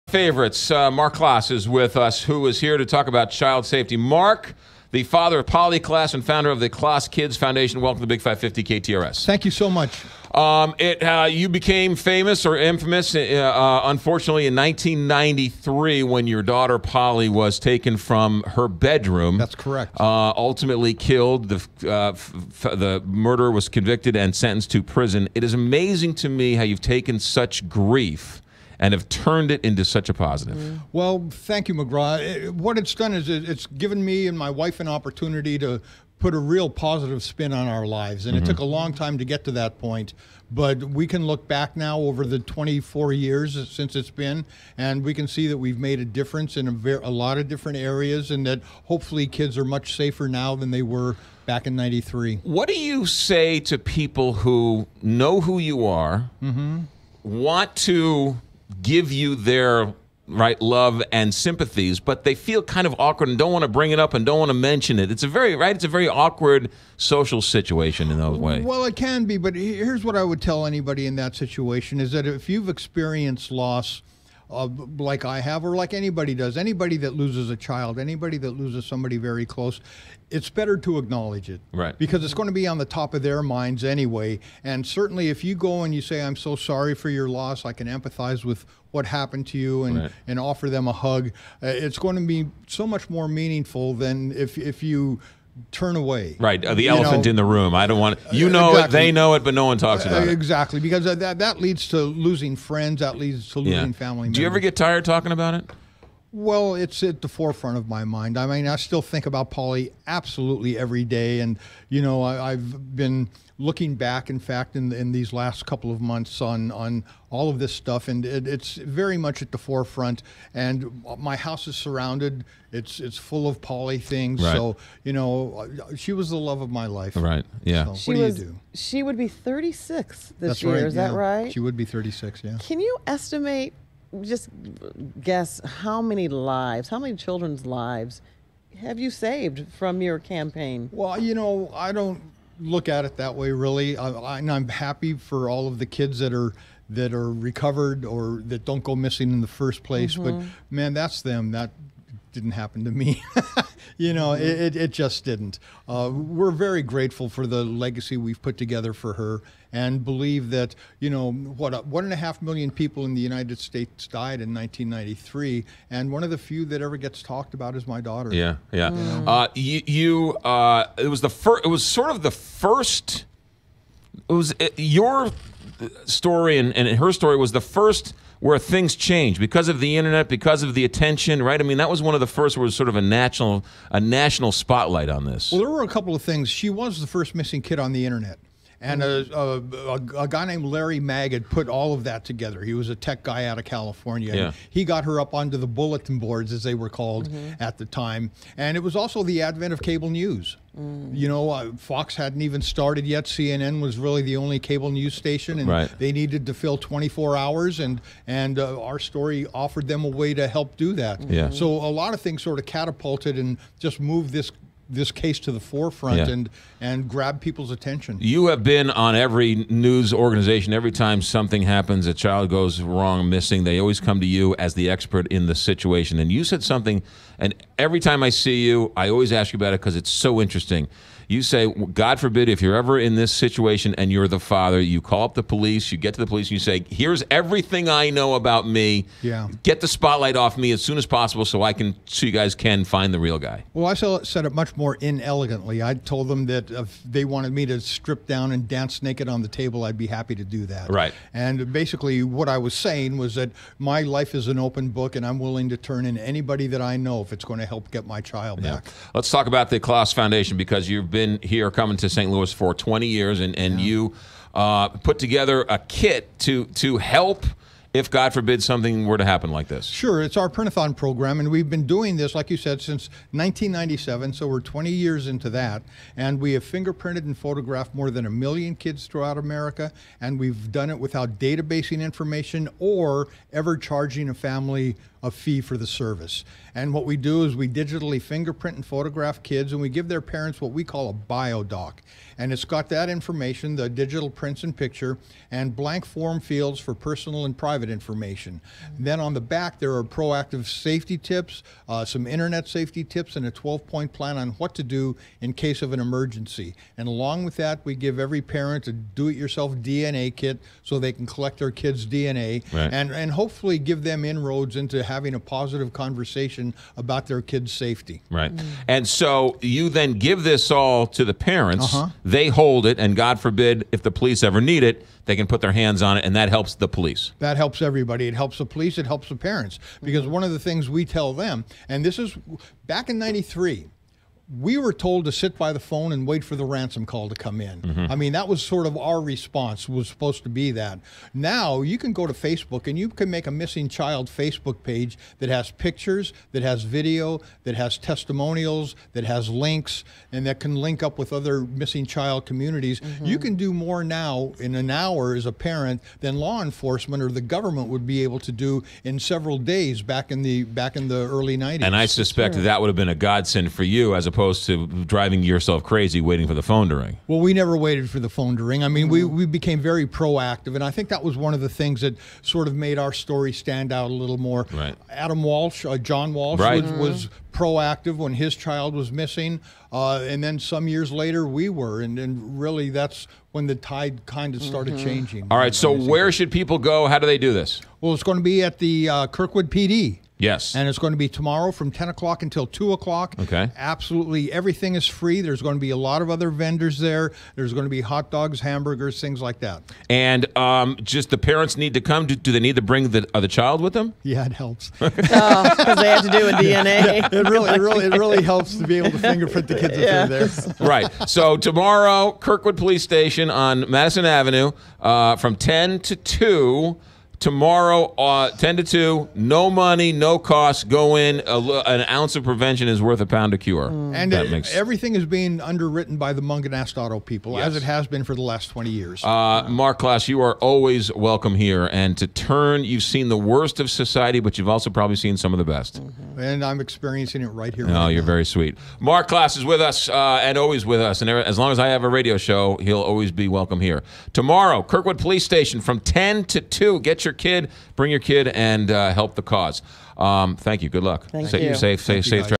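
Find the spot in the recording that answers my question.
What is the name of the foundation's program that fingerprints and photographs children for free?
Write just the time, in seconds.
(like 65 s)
270 s.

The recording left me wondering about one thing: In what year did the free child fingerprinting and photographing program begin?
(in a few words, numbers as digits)
1997.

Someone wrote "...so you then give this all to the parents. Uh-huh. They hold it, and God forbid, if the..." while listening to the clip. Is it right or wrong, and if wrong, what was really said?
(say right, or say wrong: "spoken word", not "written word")
right.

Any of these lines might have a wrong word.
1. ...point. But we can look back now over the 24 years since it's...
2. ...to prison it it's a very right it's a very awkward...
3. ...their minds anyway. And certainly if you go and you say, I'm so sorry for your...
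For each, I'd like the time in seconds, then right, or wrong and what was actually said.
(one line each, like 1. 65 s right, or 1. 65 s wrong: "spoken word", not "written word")
1. 39 s right
2. 64 s wrong: "mention", not "prison"
3. 83 s right.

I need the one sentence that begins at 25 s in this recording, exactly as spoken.
It is amazing to me how you've taken such grief and have turned it into such a positive.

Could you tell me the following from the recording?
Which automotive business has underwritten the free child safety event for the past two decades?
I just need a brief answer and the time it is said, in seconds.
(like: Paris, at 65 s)
Mungenast Auto, at 426 s.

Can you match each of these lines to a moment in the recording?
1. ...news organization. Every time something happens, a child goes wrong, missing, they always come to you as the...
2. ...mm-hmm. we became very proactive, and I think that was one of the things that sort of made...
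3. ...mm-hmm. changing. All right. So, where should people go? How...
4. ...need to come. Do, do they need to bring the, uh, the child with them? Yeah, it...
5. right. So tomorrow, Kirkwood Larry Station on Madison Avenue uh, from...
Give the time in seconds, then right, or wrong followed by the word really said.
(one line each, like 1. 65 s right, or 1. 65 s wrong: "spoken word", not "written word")
1. 219 s right
2. 369 s right
3. 384 s right
4. 401 s right
5. 410 s wrong: "Police", not "Larry".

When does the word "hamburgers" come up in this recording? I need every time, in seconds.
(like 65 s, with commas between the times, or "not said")
398 s.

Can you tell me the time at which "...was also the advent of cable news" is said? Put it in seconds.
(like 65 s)
198 s.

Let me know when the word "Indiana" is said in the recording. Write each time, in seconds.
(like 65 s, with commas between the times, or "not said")
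not said.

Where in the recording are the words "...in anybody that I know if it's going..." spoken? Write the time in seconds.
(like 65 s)
256 s.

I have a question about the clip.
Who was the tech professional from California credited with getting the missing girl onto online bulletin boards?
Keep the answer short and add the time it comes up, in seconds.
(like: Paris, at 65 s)
Larry Magid, at 190 s.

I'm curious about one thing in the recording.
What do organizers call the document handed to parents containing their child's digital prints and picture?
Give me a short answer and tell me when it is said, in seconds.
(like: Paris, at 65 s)
bio doc, at 291 s.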